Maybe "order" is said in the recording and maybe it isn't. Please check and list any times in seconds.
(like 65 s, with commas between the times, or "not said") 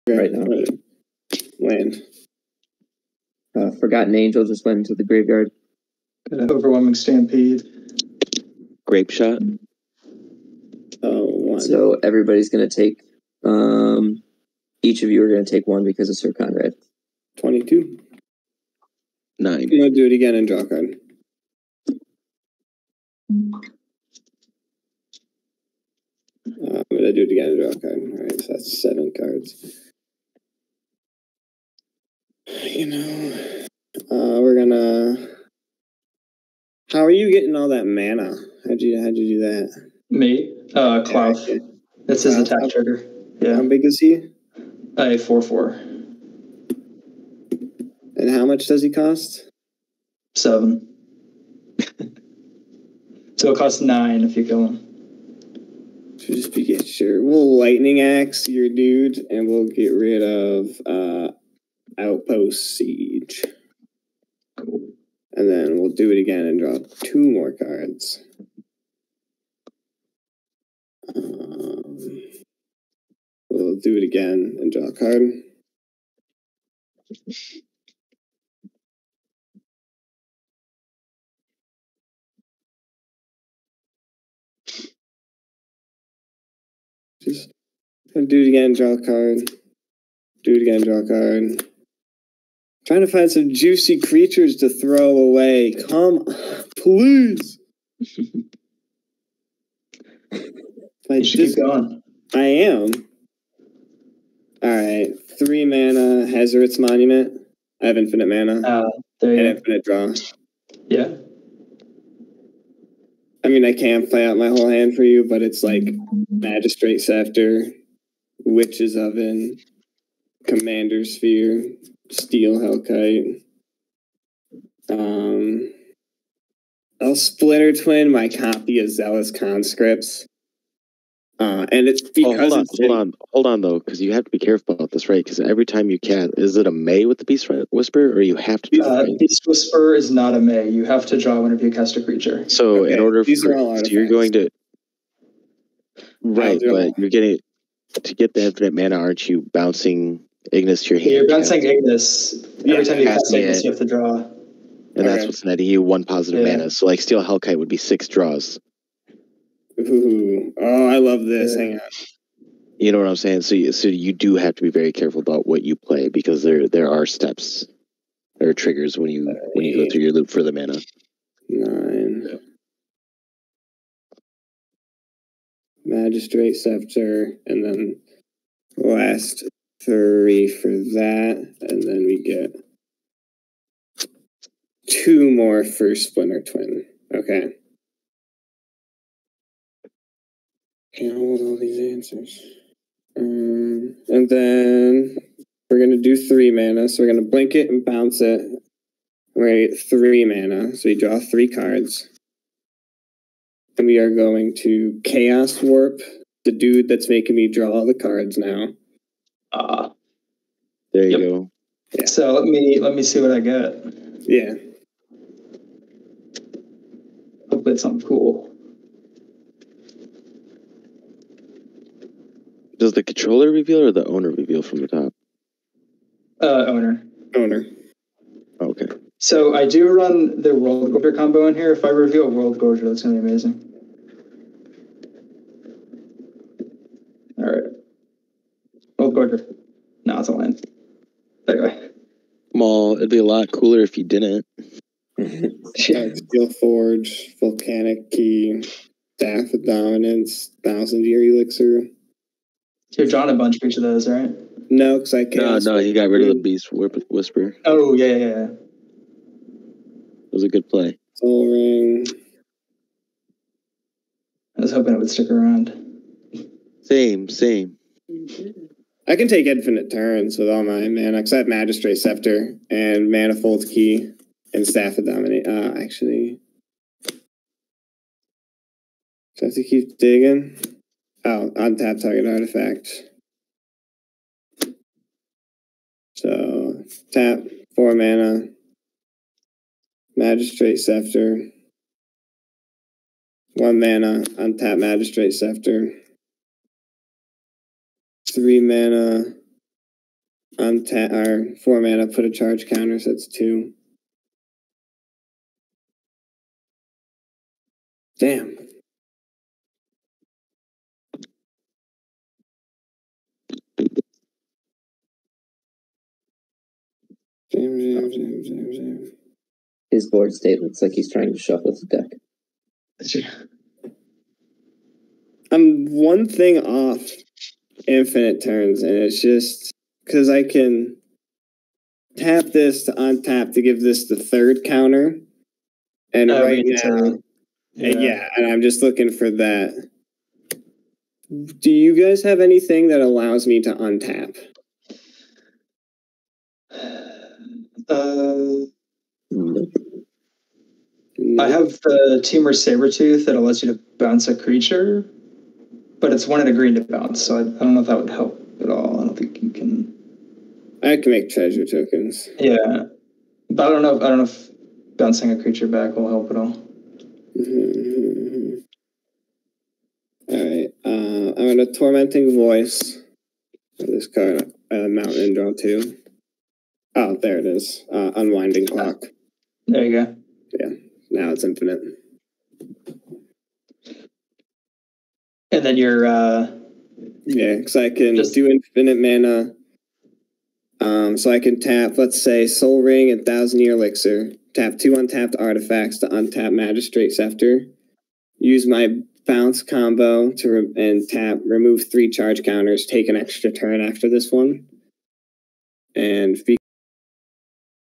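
142 s.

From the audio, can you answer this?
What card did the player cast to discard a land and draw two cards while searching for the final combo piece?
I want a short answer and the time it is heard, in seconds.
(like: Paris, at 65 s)
Tormenting Voice, at 371 s.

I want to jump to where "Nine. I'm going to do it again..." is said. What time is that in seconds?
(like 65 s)
19 s.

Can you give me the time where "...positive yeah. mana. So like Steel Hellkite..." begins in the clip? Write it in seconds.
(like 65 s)
156 s.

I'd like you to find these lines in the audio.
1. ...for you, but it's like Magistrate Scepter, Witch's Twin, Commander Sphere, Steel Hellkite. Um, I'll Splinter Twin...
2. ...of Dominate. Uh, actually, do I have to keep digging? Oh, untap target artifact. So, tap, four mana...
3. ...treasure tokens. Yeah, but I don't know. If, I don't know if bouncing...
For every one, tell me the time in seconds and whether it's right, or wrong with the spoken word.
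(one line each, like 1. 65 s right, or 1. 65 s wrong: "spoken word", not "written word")
1. 114 s wrong: "Oven", not "Twin"
2. 274 s right
3. 361 s right.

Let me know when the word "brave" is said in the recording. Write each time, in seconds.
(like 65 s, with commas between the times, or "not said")
not said.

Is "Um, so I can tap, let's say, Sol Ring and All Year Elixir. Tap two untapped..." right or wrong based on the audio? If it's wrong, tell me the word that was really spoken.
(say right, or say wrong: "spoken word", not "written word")
wrong: "Thousand", not "All".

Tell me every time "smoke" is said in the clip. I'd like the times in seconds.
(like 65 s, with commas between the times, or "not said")
not said.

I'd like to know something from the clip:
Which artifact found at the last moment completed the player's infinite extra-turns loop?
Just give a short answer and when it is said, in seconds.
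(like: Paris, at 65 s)
Unwinding Clock, at 378 s.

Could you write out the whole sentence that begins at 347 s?
Uh, I have the Teamer tooth that allows you to bounce a creature, but it's one at a green to bounce.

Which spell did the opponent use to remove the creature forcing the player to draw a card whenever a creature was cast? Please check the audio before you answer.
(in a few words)
Chaos Warp.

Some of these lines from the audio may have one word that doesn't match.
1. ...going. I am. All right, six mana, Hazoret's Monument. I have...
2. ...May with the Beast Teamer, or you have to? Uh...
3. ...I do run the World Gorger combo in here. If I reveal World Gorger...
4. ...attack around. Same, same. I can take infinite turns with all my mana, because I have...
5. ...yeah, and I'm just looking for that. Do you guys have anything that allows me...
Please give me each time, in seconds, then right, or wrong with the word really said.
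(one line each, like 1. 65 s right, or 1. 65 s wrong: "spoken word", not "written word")
1. 101 s wrong: "three", not "six"
2. 136 s wrong: "Whisperer", not "Teamer"
3. 229 s right
4. 265 s wrong: "stick", not "attack"
5. 338 s right.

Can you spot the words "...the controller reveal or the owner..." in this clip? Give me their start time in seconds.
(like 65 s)
222 s.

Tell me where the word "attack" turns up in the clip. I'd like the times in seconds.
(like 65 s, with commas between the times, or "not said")
42 s.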